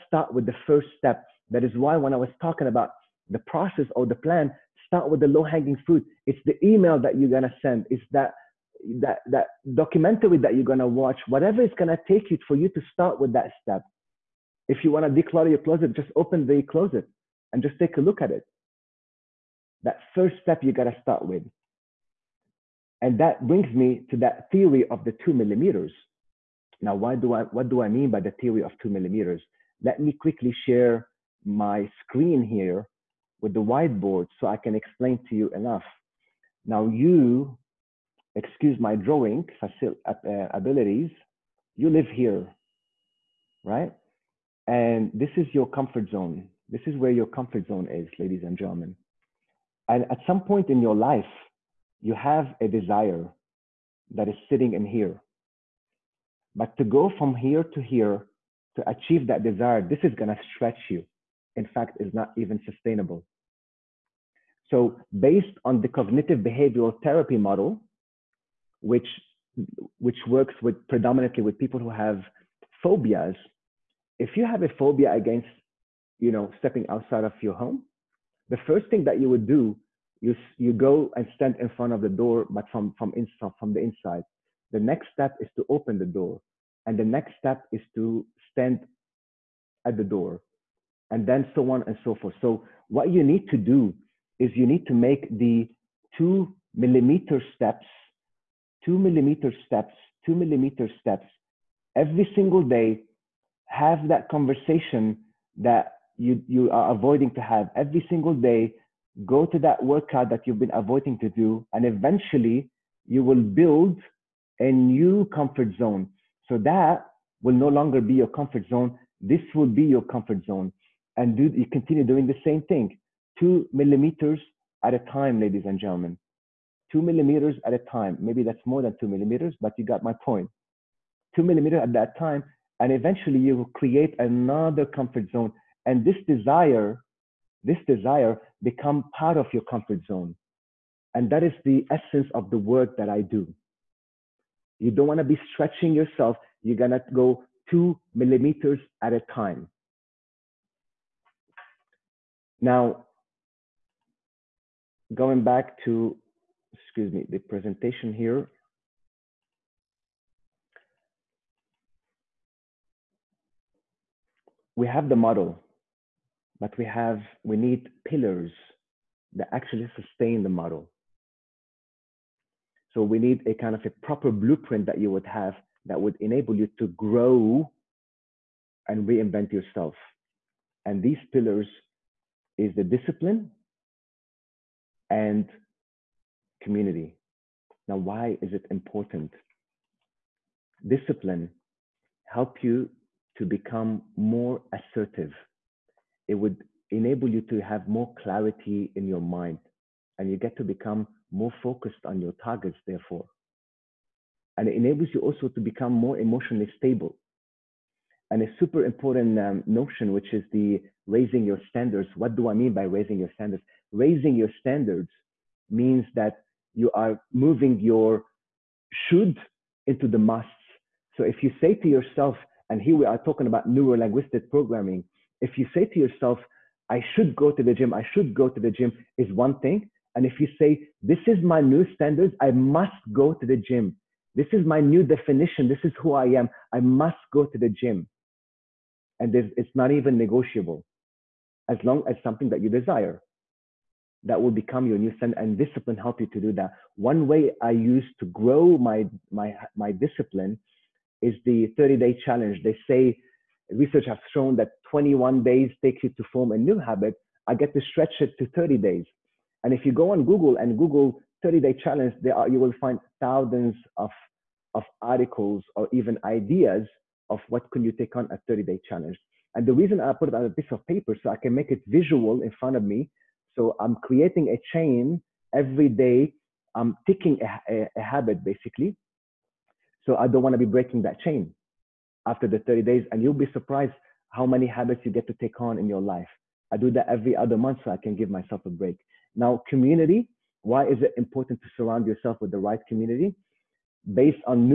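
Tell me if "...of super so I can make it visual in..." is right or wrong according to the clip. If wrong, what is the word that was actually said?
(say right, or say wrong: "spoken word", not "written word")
wrong: "paper", not "super".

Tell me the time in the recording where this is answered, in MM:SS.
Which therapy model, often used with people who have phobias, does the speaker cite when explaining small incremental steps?
01:05.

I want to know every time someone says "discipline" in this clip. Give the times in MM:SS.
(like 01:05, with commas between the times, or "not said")
03:02, 03:10, 04:05, 04:09.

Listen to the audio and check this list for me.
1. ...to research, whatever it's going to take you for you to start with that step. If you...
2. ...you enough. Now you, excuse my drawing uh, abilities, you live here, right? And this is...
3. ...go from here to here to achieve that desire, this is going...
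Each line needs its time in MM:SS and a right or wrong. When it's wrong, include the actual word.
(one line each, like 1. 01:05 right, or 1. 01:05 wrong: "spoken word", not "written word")
1. 00:10 wrong: "watch", not "research"
2. 00:35 right
3. 00:56 right.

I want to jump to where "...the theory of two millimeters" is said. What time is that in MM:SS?
00:28.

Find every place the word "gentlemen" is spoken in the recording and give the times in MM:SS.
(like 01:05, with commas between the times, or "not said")
00:48, 02:05.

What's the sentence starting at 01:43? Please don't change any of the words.
Have that conversation that you, you are avoiding to have every single day.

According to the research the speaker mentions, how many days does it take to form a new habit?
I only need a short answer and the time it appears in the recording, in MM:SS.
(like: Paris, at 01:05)
21, at 04:14.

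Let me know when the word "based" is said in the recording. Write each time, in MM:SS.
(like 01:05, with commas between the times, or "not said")
01:05, 04:54.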